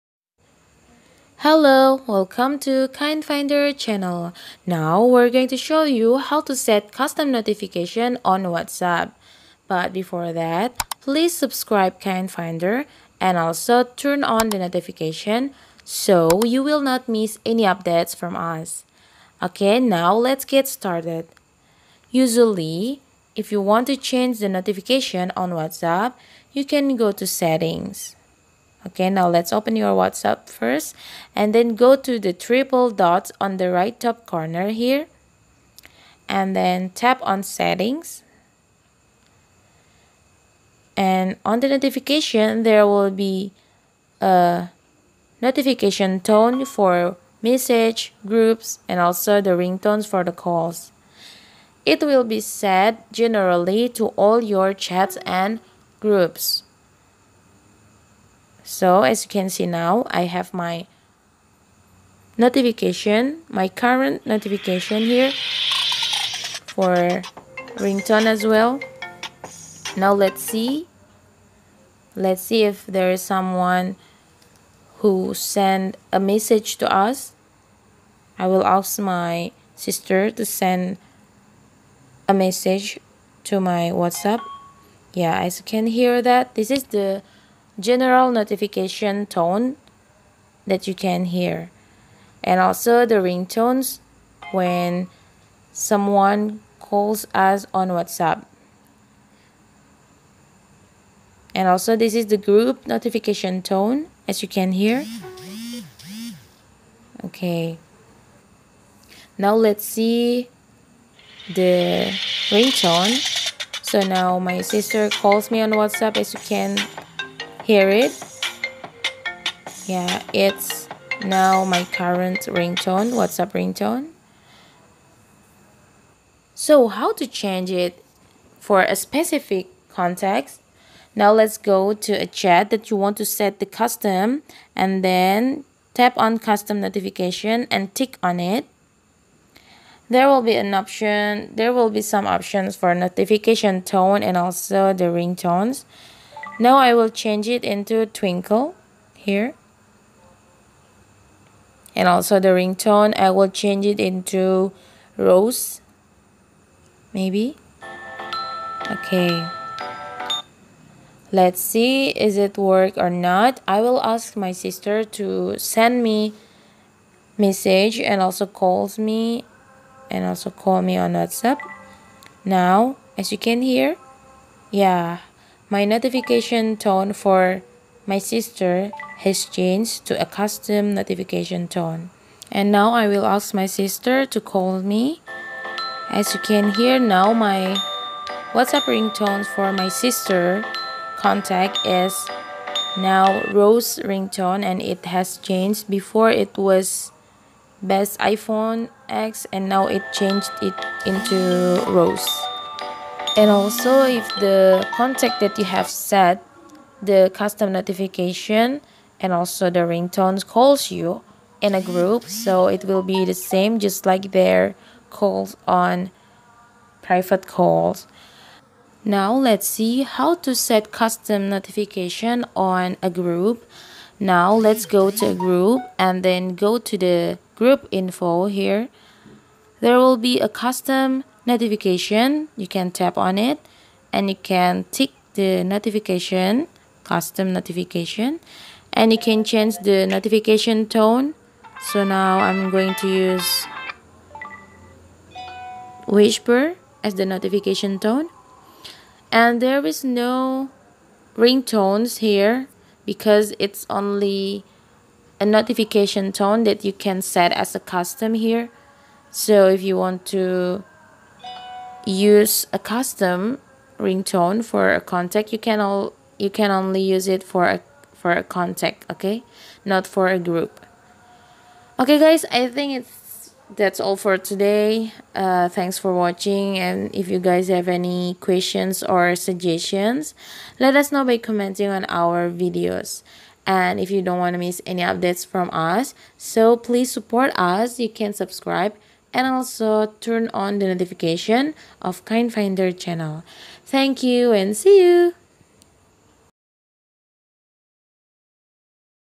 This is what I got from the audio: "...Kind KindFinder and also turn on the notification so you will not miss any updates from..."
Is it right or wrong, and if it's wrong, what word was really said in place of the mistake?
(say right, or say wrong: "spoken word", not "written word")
wrong: "Finder", not "KindFinder".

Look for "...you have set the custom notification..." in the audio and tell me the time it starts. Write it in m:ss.
3:25.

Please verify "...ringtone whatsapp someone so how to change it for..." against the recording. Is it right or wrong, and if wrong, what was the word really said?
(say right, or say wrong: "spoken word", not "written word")
wrong: "ringtone", not "someone".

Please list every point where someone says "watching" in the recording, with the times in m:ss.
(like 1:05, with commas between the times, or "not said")
4:36.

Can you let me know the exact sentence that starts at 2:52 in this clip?
Now, as you can hear, yeah, my notification tone for my sister has changed to a custom notification tone.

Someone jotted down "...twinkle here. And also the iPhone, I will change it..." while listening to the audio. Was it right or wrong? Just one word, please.
wrong.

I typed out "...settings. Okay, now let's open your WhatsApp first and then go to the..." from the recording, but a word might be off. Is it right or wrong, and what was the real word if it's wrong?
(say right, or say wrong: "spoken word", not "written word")
right.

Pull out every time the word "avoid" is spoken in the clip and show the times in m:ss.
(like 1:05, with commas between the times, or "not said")
not said.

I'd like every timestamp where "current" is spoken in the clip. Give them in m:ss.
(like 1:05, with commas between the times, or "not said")
1:03, 2:01.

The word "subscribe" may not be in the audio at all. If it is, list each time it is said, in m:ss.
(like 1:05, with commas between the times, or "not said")
0:11, 4:48.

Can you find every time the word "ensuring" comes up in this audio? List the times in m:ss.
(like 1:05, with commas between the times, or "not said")
not said.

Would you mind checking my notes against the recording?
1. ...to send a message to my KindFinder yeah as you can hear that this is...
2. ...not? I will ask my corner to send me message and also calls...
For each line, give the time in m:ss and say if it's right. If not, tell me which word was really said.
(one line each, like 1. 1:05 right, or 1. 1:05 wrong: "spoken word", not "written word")
1. 1:20 wrong: "WhatsApp", not "KindFinder"
2. 2:43 wrong: "sister", not "corner".